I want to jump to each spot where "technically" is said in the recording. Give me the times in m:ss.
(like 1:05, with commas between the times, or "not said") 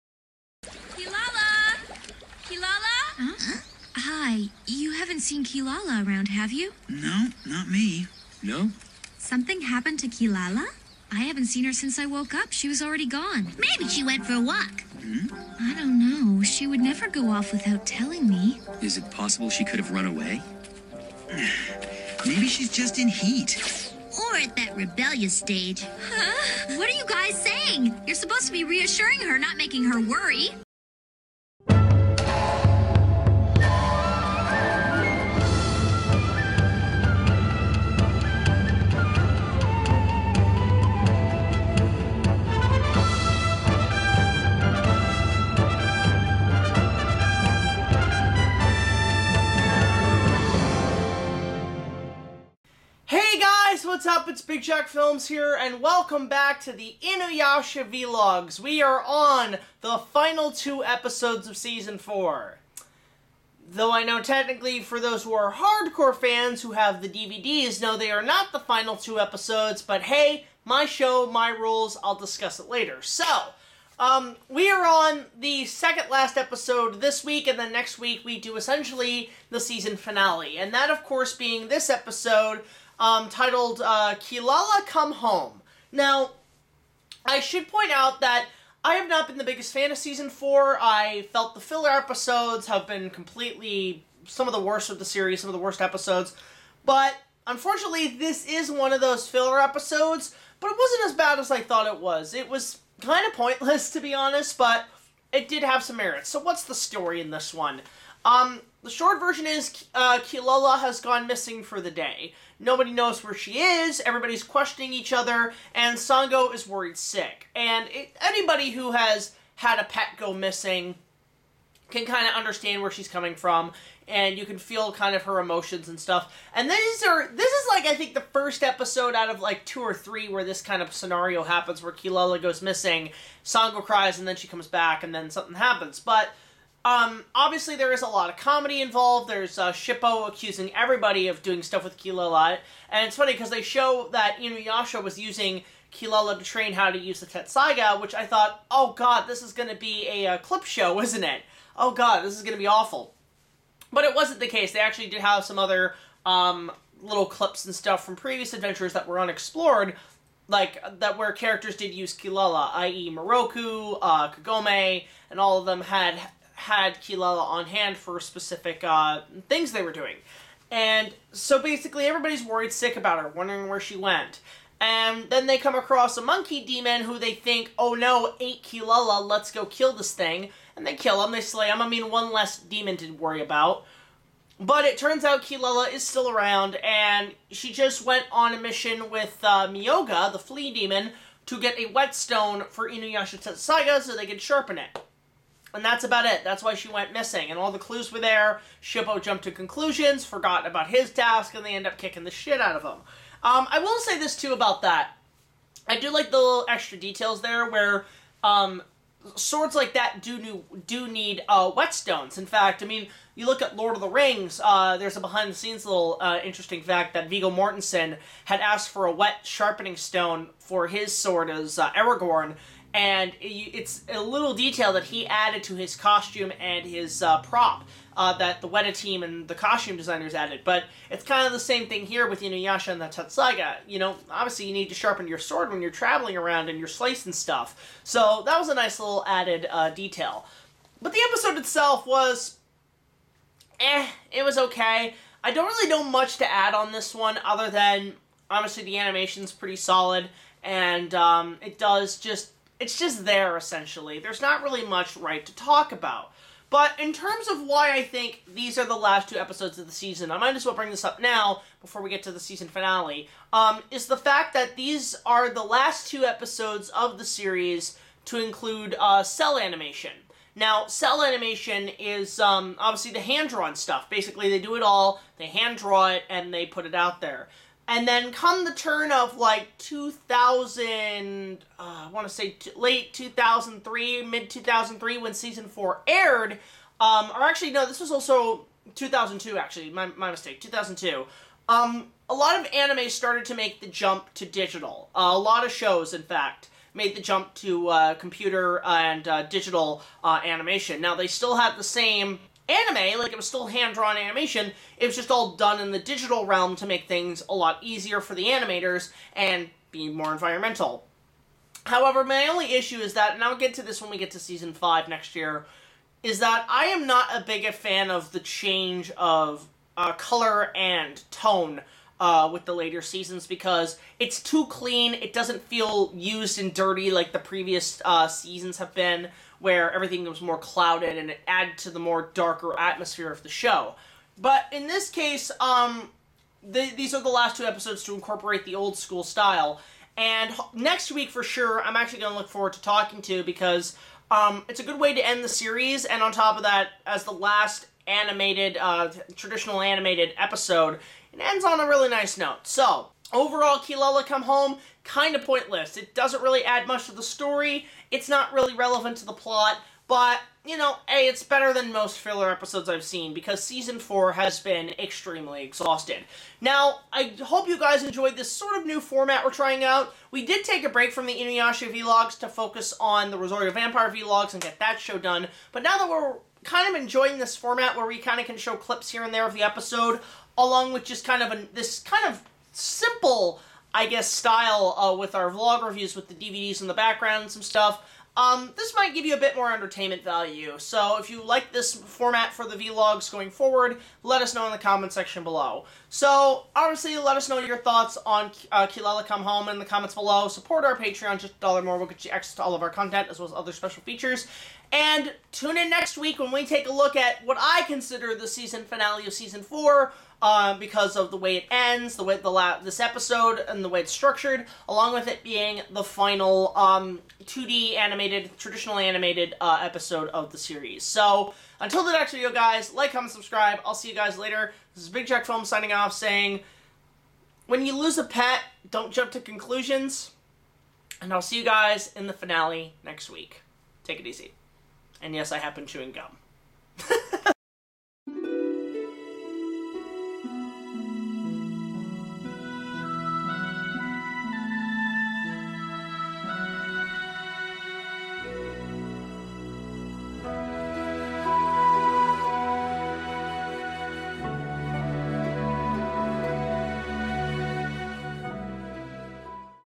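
1:04.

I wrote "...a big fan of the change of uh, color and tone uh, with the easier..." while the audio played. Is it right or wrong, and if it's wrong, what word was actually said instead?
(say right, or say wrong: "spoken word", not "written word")
wrong: "later", not "easier".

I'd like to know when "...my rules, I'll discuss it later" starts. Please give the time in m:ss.
1:11.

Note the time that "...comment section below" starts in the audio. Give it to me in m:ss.
6:34.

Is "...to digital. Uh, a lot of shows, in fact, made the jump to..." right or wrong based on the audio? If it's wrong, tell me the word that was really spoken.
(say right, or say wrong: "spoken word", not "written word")
right.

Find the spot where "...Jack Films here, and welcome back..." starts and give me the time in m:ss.
0:54.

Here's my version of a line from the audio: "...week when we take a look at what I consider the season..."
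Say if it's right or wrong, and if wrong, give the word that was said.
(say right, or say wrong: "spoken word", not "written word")
right.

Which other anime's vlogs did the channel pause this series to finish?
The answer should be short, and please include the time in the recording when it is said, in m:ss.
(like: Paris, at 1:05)
Rosario Vampire, at 6:13.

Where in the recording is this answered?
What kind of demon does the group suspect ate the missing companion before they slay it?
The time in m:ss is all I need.
2:56.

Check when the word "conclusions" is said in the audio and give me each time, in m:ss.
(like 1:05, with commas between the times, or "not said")
3:19, 7:09.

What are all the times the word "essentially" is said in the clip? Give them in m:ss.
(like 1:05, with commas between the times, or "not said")
1:18, 4:13.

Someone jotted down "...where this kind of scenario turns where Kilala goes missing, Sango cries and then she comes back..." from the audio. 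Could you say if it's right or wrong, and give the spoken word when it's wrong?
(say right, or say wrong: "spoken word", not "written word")
wrong: "happens", not "turns".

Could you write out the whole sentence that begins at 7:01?
So until the next video, guys, like, comment, subscribe.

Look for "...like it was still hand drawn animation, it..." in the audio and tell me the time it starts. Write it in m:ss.
5:03.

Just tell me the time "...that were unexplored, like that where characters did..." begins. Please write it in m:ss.
2:38.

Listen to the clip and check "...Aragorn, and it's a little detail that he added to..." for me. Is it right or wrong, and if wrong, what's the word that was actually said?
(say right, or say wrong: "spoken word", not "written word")
right.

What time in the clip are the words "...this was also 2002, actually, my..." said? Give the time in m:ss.
4:47.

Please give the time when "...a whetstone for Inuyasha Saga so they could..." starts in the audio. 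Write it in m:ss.
3:11.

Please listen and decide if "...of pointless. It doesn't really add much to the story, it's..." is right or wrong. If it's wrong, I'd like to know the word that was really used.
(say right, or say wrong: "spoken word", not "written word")
right.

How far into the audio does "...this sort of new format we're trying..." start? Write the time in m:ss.
6:08.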